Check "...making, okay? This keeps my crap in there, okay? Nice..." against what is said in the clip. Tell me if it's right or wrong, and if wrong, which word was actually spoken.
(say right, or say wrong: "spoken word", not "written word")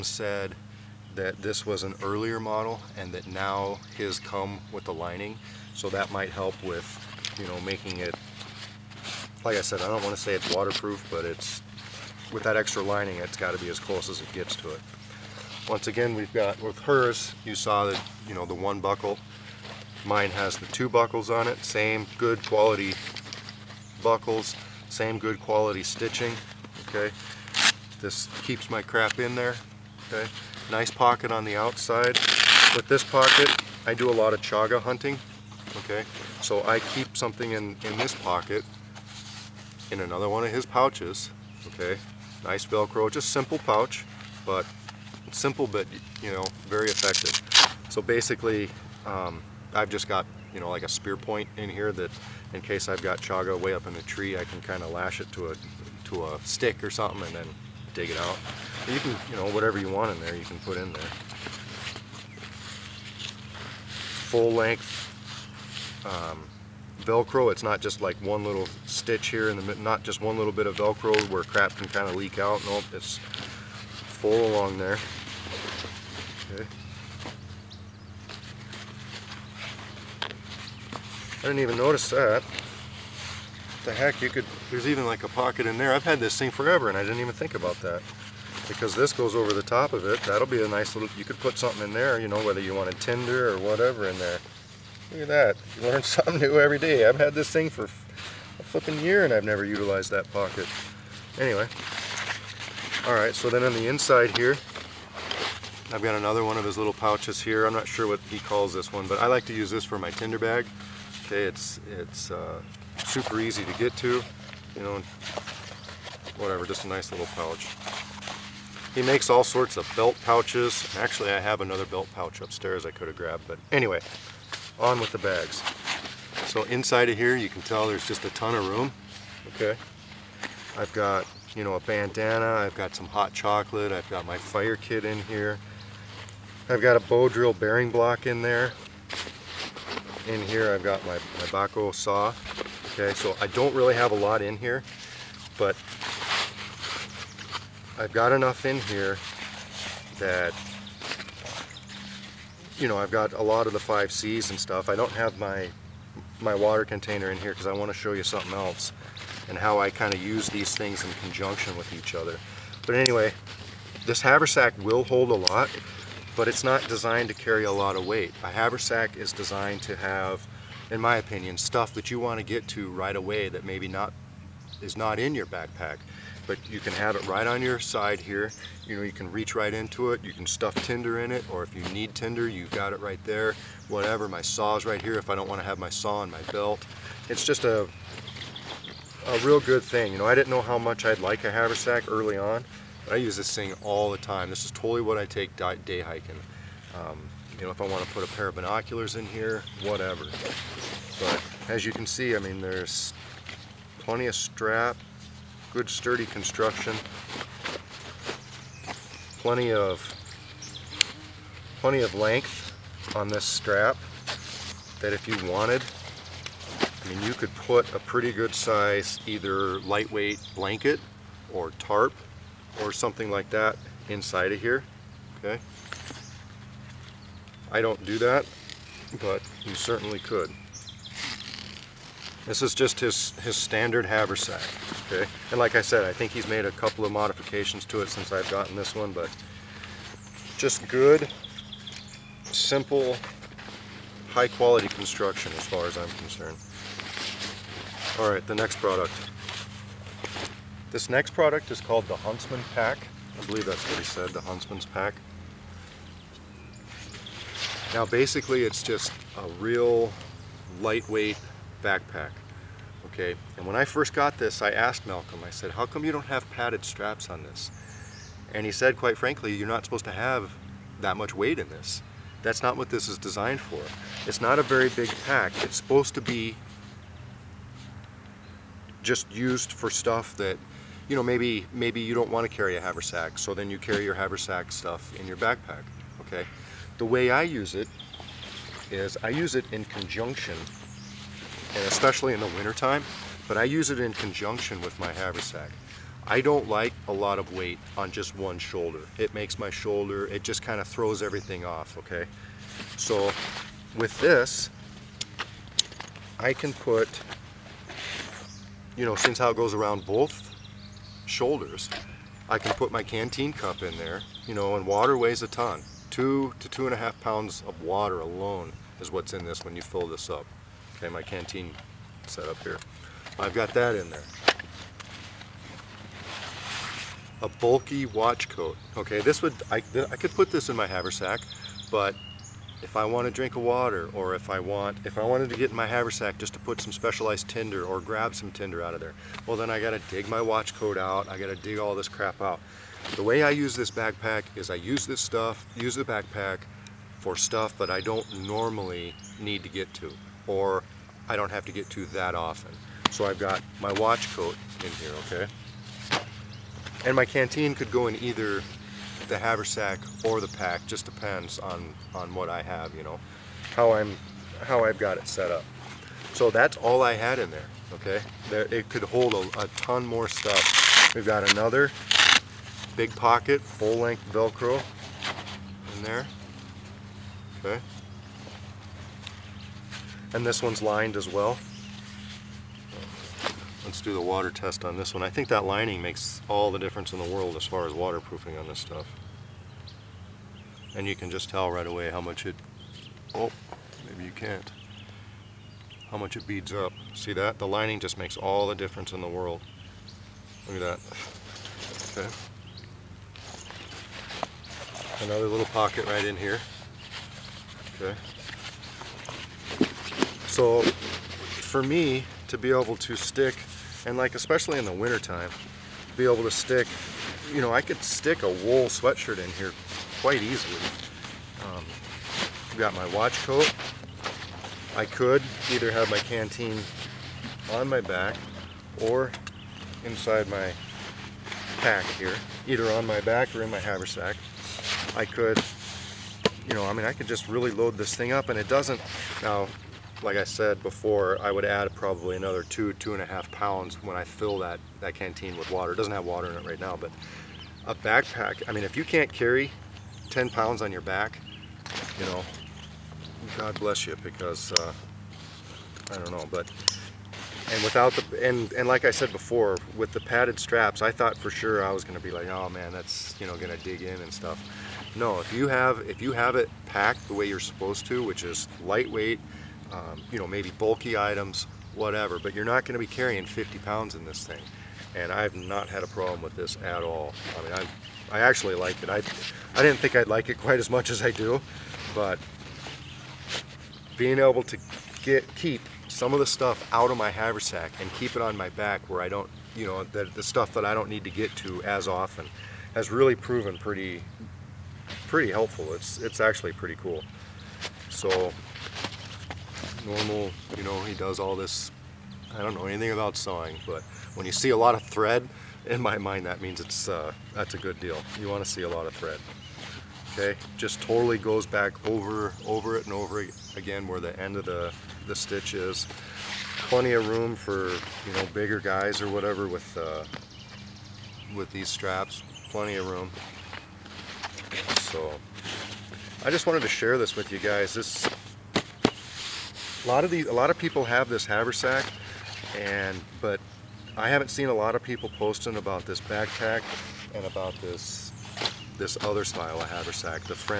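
wrong: "stitching", not "making".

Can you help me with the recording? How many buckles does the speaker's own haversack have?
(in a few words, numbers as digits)
2.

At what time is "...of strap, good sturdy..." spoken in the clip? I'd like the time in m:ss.
3:24.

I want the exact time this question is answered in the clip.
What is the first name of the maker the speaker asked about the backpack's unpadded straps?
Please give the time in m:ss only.
4:25.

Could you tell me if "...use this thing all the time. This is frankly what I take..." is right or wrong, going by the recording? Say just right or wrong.
wrong.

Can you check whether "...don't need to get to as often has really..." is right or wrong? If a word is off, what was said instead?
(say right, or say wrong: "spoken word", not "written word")
right.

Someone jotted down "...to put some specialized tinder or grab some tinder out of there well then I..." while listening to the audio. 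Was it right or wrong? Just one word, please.
right.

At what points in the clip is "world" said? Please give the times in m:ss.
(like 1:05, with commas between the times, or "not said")
6:27, 6:39.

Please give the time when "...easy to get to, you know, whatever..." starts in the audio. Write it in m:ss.
1:53.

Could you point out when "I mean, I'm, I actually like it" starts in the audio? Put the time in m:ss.
7:57.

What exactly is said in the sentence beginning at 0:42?
Nice Velcro, just simple pouch, but simple but you know very effective.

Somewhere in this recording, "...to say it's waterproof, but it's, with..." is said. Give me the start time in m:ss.
0:10.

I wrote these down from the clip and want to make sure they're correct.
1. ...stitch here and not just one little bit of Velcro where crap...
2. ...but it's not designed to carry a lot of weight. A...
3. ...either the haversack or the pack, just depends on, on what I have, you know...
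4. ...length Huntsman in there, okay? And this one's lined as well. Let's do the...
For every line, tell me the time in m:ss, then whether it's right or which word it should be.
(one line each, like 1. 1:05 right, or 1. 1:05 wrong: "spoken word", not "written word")
1. 1:08 right
2. 2:46 right
3. 5:58 right
4. 6:13 wrong: "Velcro", not "Huntsman".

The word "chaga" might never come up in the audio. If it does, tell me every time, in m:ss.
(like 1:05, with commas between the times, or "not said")
0:34, 0:53.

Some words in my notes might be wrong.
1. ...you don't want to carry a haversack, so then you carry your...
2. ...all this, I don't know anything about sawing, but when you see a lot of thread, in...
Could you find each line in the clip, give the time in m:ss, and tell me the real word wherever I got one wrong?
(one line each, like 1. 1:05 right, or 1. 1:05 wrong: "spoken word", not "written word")
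1. 4:42 right
2. 8:21 right.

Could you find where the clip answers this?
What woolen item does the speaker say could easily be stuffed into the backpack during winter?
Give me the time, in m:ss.
6:58.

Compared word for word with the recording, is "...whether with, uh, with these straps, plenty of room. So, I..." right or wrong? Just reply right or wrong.
wrong.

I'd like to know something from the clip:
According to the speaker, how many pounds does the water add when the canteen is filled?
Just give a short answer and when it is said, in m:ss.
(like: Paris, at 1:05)
2 to 2.5 pounds, at 5:16.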